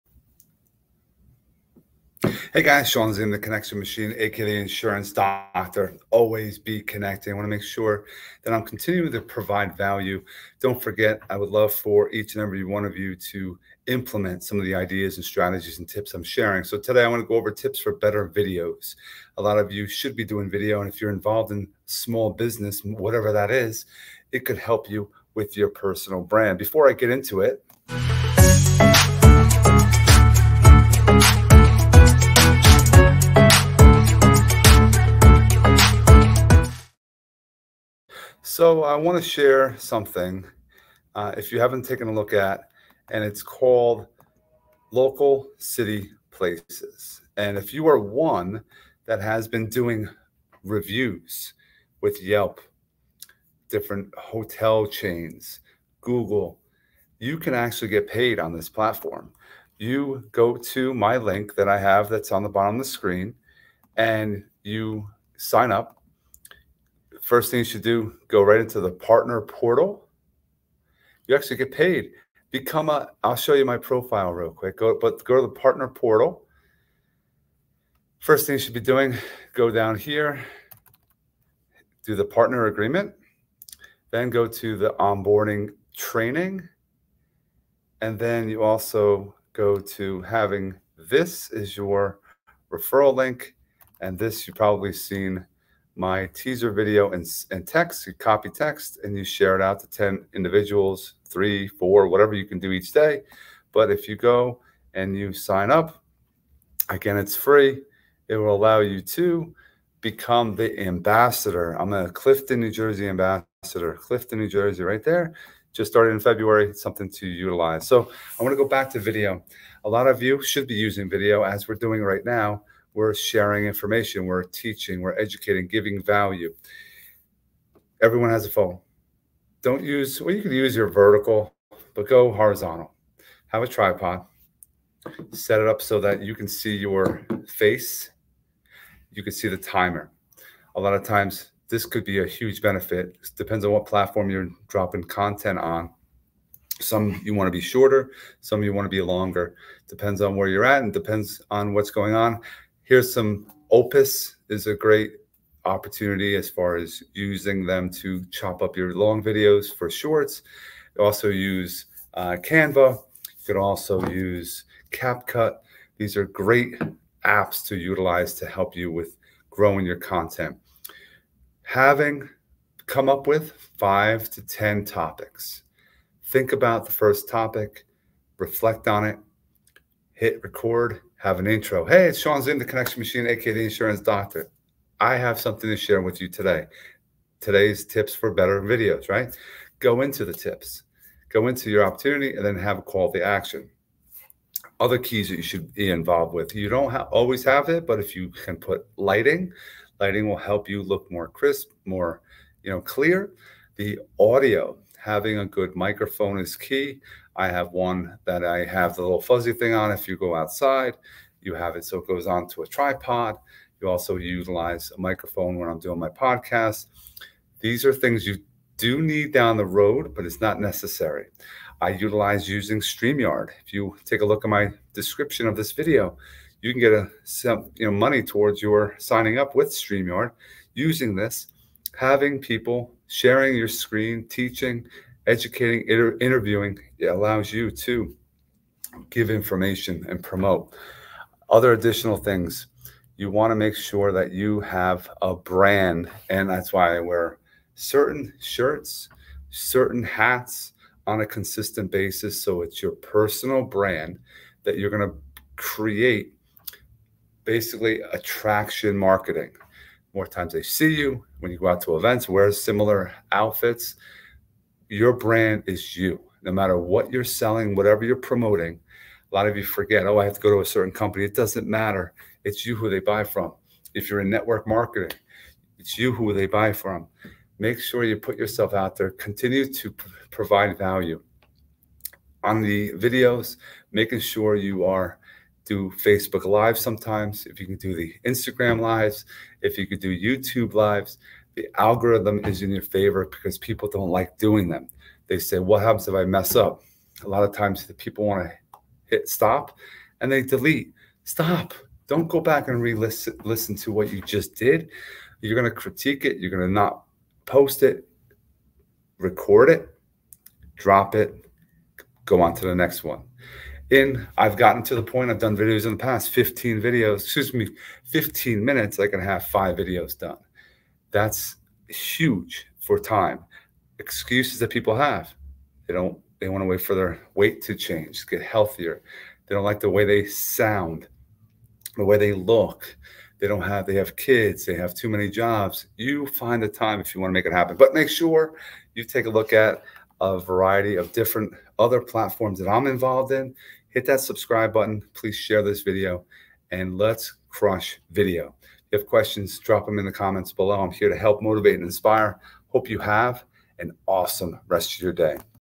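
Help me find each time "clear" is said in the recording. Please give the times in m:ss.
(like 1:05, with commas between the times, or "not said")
3:22.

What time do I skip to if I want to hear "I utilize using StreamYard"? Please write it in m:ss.
3:41.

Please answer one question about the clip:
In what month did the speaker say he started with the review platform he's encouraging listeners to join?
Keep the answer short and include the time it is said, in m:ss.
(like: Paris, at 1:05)
February, at 1:55.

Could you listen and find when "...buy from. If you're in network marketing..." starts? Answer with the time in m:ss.
4:32.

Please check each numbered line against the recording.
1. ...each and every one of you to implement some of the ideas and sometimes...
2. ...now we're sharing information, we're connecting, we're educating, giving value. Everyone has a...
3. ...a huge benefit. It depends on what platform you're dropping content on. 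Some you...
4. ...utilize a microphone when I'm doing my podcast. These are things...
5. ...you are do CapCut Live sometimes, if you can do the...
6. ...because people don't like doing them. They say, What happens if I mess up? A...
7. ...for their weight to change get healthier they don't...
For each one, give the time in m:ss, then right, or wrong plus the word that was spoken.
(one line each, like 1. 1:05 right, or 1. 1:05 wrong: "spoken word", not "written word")
1. 0:12 wrong: "strategies", not "sometimes"
2. 2:02 wrong: "teaching", not "connecting"
3. 2:22 right
4. 3:34 right
5. 4:44 wrong: "Facebook", not "CapCut"
6. 4:53 right
7. 5:26 right.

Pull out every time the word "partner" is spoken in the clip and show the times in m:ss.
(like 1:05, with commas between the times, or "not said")
1:08, 1:15, 1:22.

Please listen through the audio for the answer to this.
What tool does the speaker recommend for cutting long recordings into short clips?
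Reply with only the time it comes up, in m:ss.
2:33.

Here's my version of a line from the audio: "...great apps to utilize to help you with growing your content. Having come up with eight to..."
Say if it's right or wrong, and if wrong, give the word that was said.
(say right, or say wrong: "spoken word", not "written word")
wrong: "five", not "eight".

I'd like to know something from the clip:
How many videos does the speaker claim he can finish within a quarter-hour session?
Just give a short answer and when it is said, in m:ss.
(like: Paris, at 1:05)
5, at 5:19.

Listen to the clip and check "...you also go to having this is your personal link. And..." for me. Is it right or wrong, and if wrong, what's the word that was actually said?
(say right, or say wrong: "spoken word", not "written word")
wrong: "referral", not "personal".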